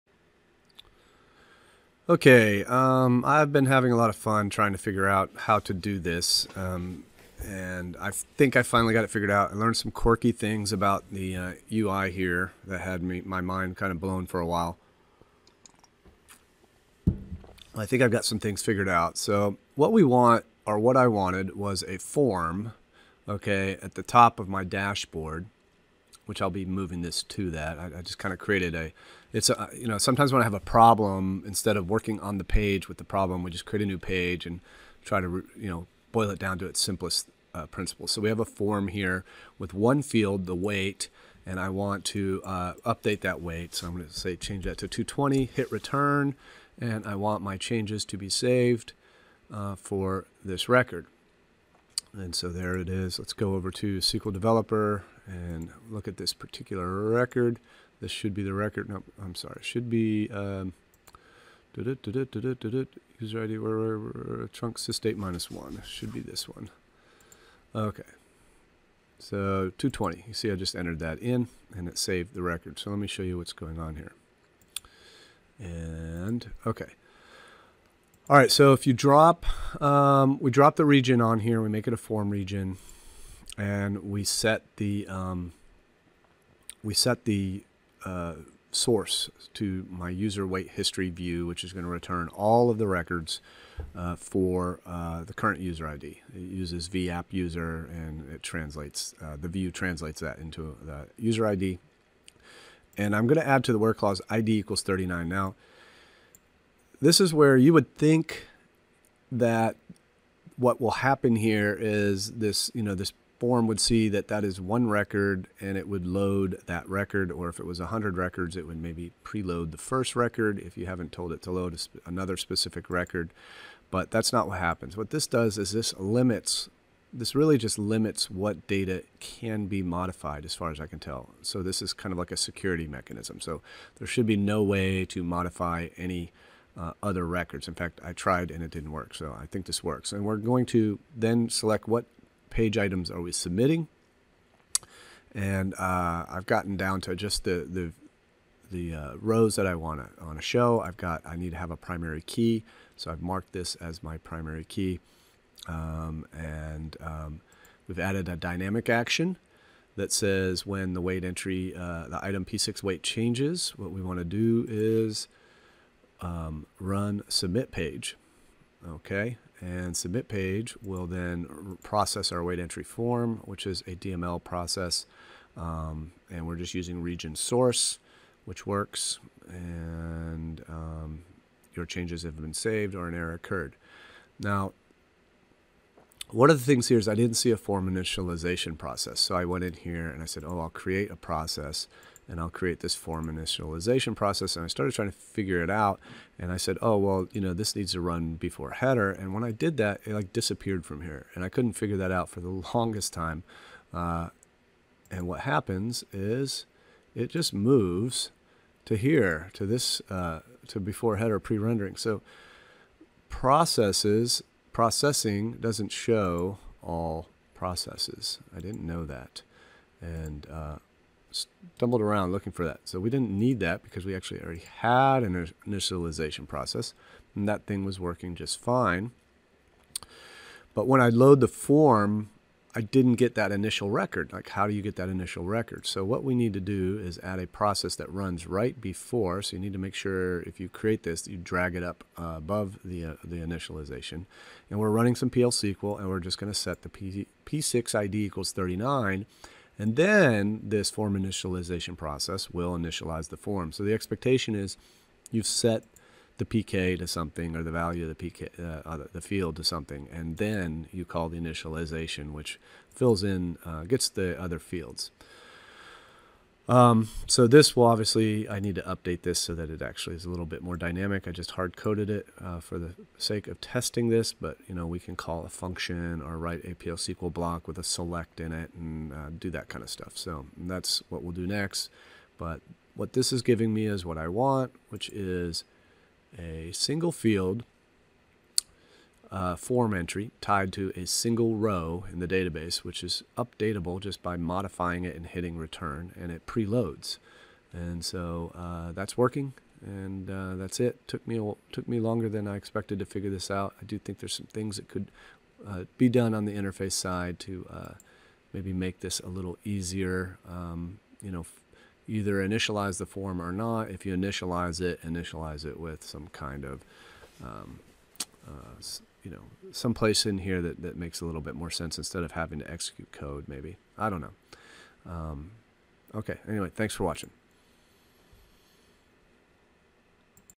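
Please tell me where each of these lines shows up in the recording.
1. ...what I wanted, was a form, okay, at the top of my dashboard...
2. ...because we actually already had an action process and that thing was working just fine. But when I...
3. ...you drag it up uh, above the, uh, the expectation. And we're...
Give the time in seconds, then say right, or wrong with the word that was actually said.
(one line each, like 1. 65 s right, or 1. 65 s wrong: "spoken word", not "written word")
1. 20 s right
2. 223 s wrong: "initialization", not "action"
3. 241 s wrong: "initialization", not "expectation".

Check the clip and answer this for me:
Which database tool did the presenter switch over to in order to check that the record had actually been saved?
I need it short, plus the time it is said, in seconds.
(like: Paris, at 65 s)
SQL Developer, at 53 s.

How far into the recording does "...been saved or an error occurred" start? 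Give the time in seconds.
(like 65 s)
182 s.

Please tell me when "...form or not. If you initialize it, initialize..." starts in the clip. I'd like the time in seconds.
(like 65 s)
313 s.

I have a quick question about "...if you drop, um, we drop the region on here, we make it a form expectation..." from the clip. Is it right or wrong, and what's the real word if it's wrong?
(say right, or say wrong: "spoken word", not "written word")
wrong: "region", not "expectation".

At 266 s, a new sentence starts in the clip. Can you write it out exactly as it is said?
Um, so this will obviously, I need to update this so that it actually is a little bit more dynamic.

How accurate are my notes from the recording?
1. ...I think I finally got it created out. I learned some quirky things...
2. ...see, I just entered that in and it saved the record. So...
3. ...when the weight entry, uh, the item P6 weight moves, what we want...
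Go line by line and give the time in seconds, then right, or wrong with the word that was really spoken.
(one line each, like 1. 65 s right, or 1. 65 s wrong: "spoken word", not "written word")
1. 7 s wrong: "figured", not "created"
2. 70 s right
3. 160 s wrong: "changes", not "moves".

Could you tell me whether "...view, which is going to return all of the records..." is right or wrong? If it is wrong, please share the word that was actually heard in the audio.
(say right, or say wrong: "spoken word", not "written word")
right.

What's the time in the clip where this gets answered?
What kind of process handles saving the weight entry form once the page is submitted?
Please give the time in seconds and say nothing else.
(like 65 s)
173 s.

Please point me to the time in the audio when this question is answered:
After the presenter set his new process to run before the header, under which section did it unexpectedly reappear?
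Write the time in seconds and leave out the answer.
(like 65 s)
210 s.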